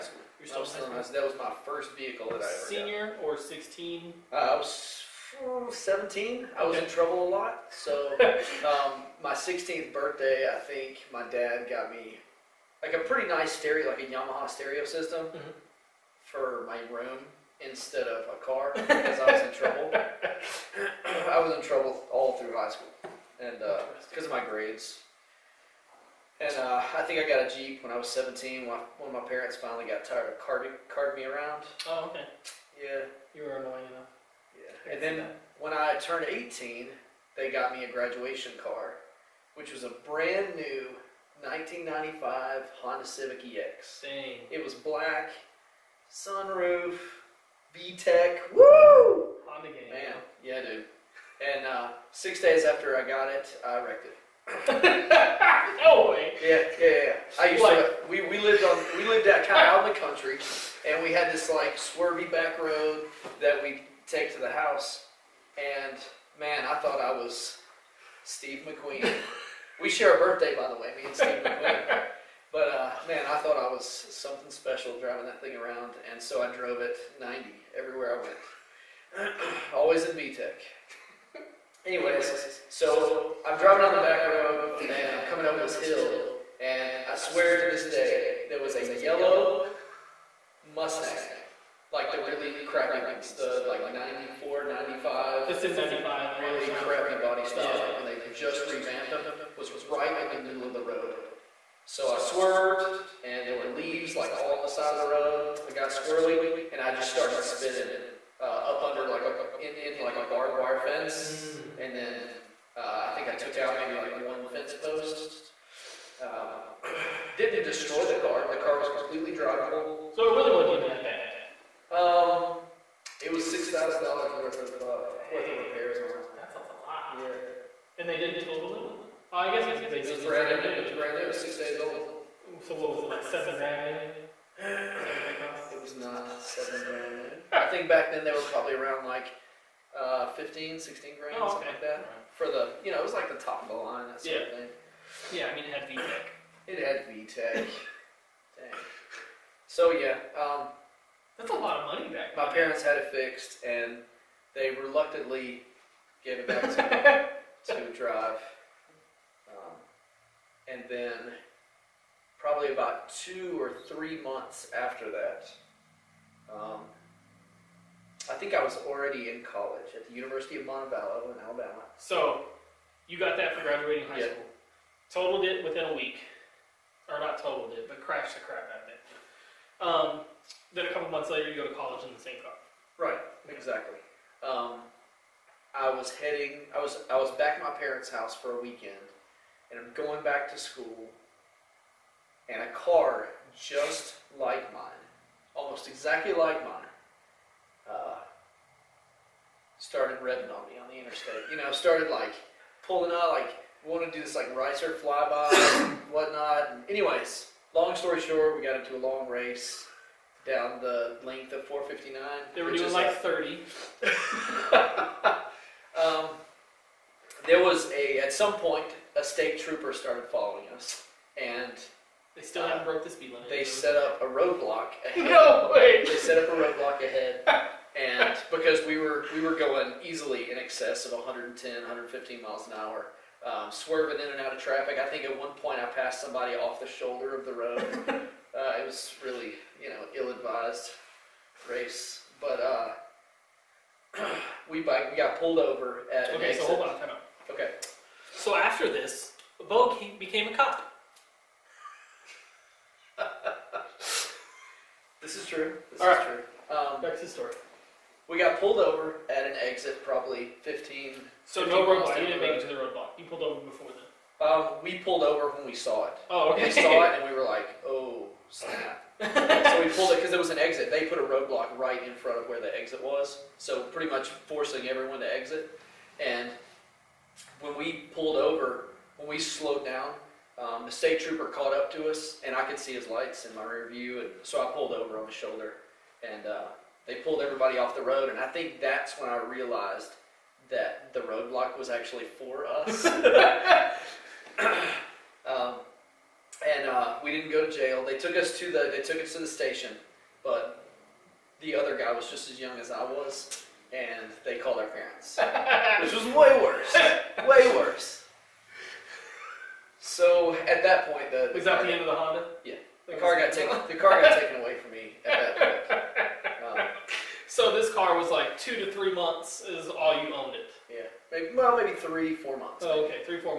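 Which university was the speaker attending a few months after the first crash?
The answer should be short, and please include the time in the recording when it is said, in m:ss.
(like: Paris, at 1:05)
University of Montevallo, at 2:50.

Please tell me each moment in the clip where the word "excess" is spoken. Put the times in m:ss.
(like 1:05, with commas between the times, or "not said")
3:50.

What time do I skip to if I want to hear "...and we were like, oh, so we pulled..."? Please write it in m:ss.
4:27.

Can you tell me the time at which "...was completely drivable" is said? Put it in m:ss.
1:58.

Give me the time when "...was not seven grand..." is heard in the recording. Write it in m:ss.
2:15.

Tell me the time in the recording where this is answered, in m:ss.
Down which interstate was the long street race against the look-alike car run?
3:31.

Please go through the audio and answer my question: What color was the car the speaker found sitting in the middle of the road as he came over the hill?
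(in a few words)
Yellow.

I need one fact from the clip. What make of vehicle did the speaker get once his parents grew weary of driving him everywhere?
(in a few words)
Jeep.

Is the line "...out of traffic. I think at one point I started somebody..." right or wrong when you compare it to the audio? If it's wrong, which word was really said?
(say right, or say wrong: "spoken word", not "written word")
wrong: "passed", not "started".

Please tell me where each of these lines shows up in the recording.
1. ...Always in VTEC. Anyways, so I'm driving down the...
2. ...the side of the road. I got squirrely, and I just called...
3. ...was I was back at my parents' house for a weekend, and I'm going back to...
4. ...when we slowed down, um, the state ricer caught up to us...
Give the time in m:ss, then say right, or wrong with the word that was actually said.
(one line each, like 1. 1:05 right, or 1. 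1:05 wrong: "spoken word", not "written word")
1. 1:19 right
2. 1:44 wrong: "started", not "called"
3. 3:06 right
4. 4:39 wrong: "trooper", not "ricer".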